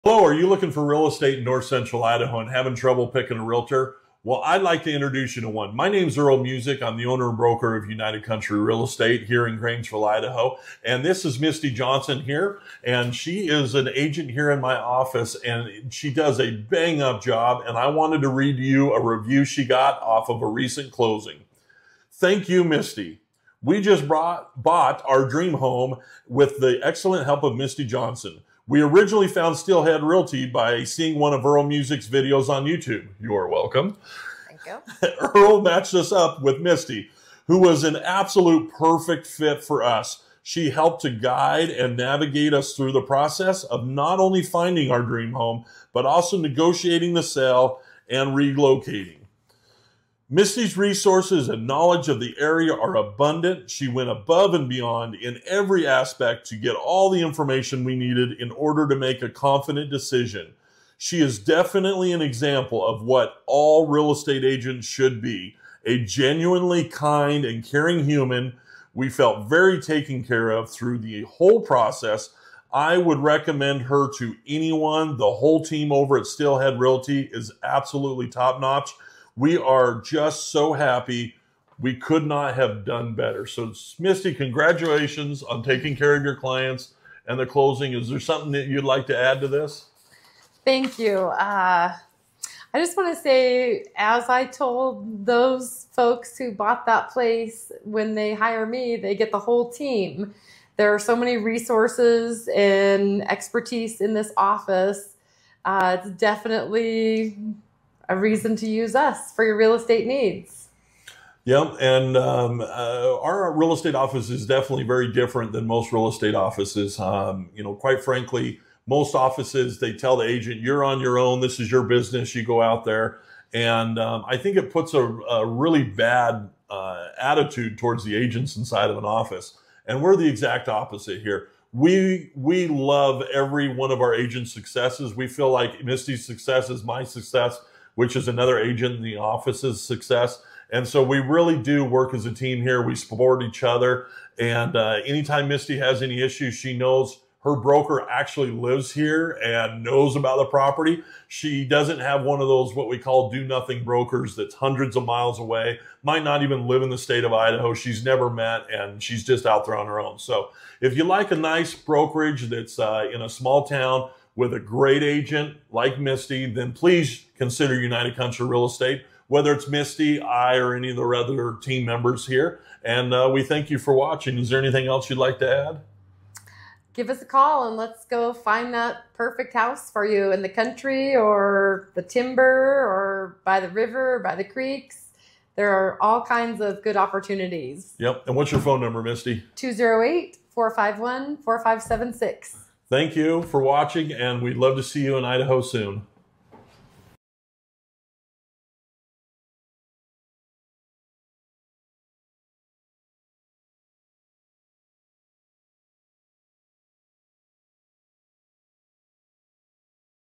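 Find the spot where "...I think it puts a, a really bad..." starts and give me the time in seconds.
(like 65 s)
124 s.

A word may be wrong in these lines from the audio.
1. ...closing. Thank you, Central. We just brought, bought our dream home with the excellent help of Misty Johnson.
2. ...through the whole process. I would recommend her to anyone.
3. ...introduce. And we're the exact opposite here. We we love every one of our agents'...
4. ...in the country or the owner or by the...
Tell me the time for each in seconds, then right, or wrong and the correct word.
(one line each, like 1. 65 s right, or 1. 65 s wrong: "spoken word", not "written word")
1. 20 s wrong: "Misty", not "Central"
2. 70 s right
3. 129 s wrong: "office", not "introduce"
4. 180 s wrong: "timber", not "owner".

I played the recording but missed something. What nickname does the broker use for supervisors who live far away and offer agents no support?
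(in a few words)
do nothing brokers.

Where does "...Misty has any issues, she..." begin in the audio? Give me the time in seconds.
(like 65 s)
145 s.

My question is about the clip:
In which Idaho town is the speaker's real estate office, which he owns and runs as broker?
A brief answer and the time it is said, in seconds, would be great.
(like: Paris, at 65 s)
Grangeville, at 9 s.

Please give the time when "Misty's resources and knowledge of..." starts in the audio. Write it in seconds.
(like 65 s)
50 s.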